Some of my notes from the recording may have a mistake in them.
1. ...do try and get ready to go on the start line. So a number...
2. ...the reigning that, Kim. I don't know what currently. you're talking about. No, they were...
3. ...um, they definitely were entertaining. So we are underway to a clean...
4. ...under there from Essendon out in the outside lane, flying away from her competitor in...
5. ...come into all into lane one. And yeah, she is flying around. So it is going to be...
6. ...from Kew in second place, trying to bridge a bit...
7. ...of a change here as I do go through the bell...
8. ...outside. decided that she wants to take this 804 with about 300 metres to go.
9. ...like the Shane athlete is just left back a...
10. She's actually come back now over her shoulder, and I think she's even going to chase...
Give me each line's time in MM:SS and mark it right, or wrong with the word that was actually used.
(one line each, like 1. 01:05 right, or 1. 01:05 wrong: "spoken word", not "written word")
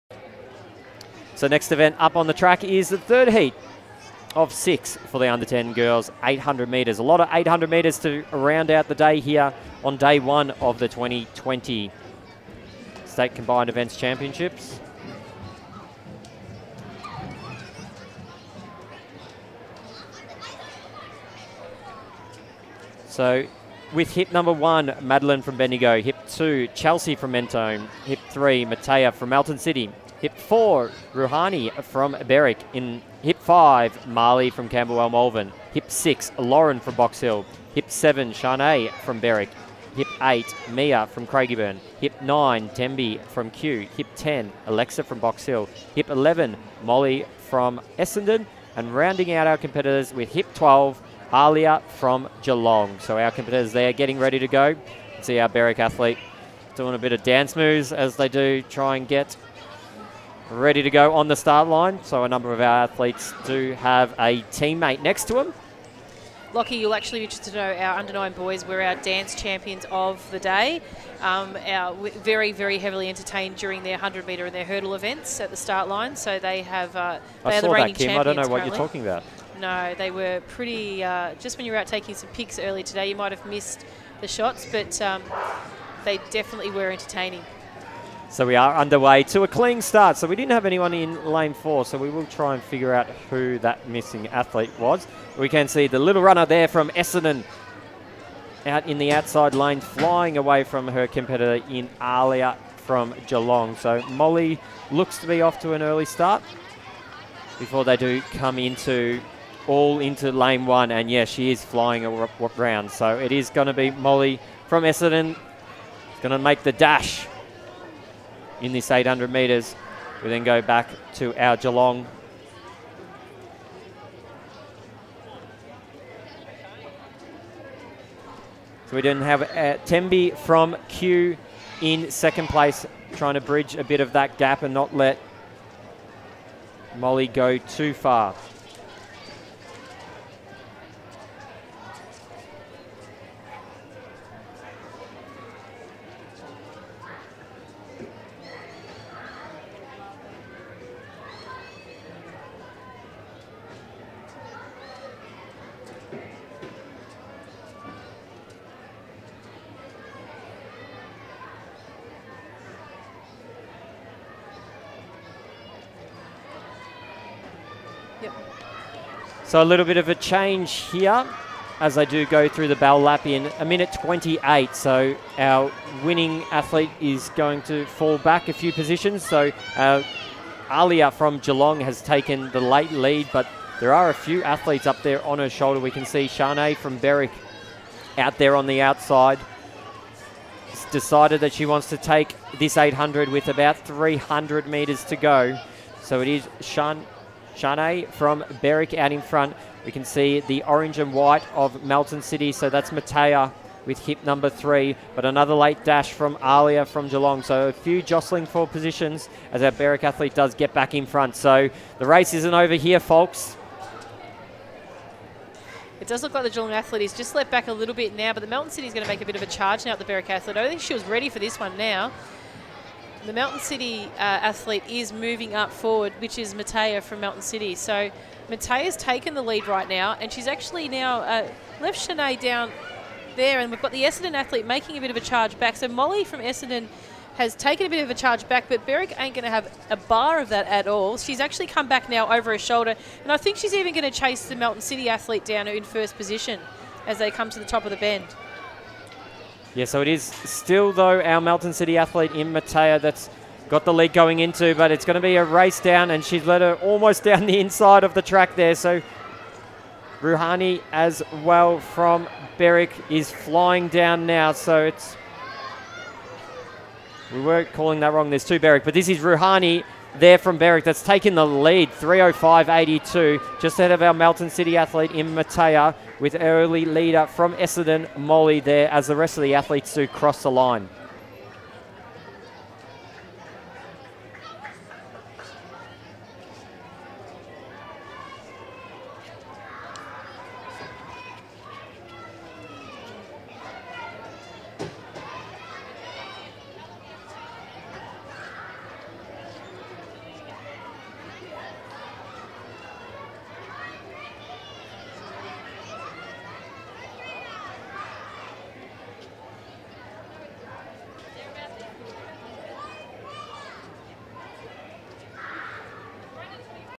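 1. 00:58 right
2. 01:17 right
3. 01:25 right
4. 01:36 wrong: "runner", not "under"
5. 01:48 right
6. 02:10 right
7. 02:49 right
8. 03:08 wrong: "800", not "804"
9. 03:36 wrong: "Geelong", not "Shane"
10. 04:01 right.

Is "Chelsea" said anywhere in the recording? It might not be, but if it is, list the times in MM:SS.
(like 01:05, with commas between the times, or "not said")
00:26.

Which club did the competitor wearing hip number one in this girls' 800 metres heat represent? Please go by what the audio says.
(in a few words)
Bendigo.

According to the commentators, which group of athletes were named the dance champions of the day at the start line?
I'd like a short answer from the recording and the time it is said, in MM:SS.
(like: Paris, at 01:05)
under nine boys, at 01:07.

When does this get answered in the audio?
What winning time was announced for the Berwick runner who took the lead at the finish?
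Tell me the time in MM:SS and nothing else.
04:31.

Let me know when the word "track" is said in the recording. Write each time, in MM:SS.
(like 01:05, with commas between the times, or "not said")
00:02, 04:18.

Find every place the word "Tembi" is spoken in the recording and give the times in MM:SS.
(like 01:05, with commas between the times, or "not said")
00:42, 02:09.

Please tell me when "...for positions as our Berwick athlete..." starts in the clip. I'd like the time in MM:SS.
03:28.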